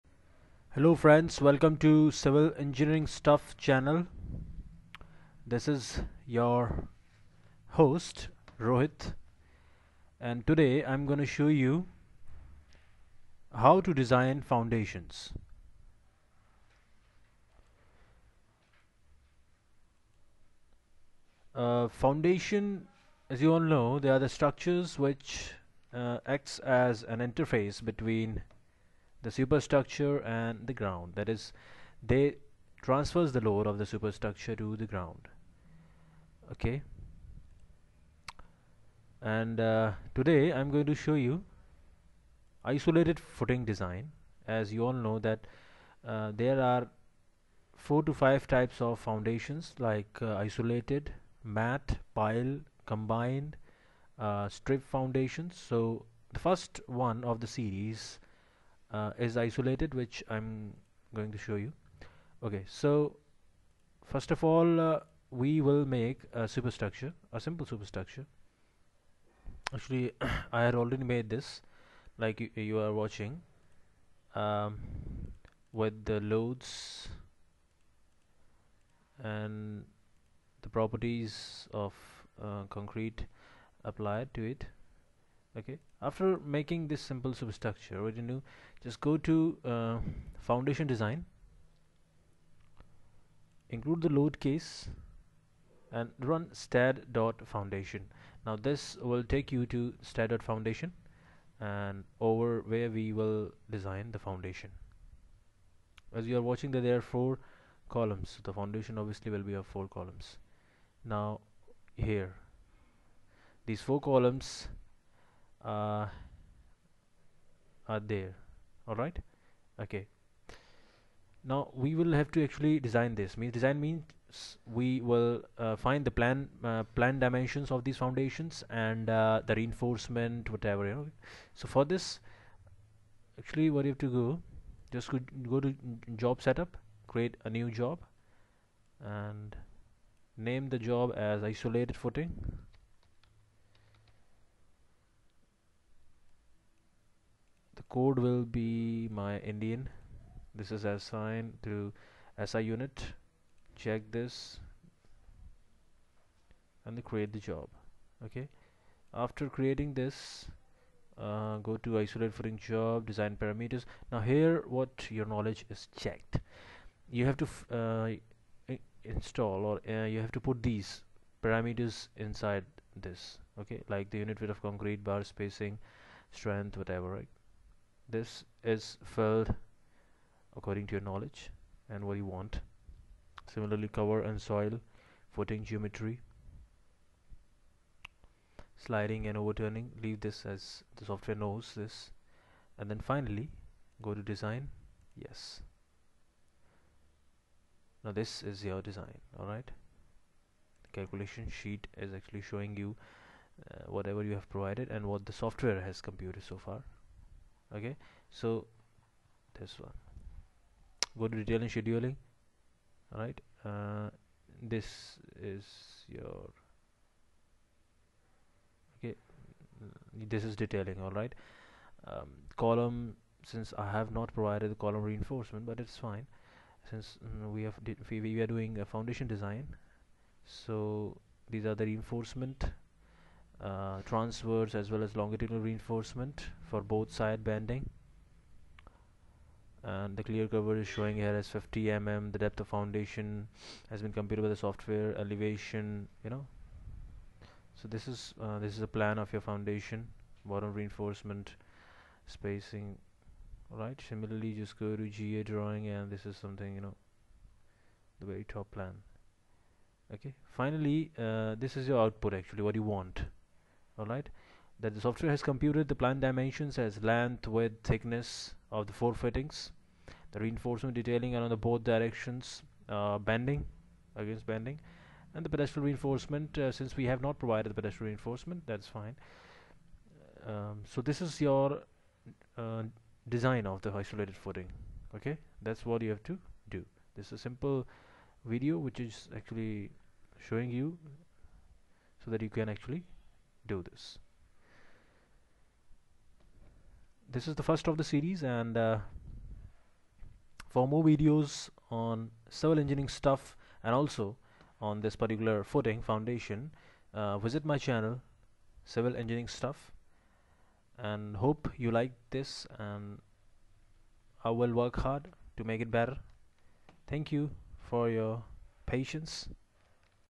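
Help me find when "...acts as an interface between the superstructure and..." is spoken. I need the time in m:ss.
0:26.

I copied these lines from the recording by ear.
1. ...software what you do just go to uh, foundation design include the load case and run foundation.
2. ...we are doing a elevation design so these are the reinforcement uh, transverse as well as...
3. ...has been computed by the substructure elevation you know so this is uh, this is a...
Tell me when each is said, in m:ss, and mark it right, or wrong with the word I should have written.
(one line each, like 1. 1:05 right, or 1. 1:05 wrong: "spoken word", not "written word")
1. 1:27 wrong: "substructure", not "software"
2. 3:48 wrong: "foundation", not "elevation"
3. 4:03 wrong: "software", not "substructure".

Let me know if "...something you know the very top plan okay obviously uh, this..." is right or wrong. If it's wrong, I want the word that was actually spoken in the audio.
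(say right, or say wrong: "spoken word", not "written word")
wrong: "finally", not "obviously".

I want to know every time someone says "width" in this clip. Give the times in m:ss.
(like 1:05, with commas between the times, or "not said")
2:54, 4:27.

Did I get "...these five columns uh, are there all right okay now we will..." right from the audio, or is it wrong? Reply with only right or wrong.
wrong.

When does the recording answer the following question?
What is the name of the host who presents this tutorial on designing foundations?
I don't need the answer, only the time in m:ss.
0:08.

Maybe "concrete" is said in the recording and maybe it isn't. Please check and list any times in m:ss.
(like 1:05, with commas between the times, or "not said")
1:22, 2:54.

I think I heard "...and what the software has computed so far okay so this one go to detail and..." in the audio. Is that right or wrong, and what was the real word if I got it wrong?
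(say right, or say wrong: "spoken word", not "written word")
right.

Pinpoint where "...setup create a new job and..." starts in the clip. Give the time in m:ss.
2:16.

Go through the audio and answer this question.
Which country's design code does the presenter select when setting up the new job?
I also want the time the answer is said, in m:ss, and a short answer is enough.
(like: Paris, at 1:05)
Indian, at 2:29.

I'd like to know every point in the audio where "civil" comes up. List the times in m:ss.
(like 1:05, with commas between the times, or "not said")
0:02, 5:02, 5:08.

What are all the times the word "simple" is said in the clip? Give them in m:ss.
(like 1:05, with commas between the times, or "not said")
1:07, 1:27, 4:47.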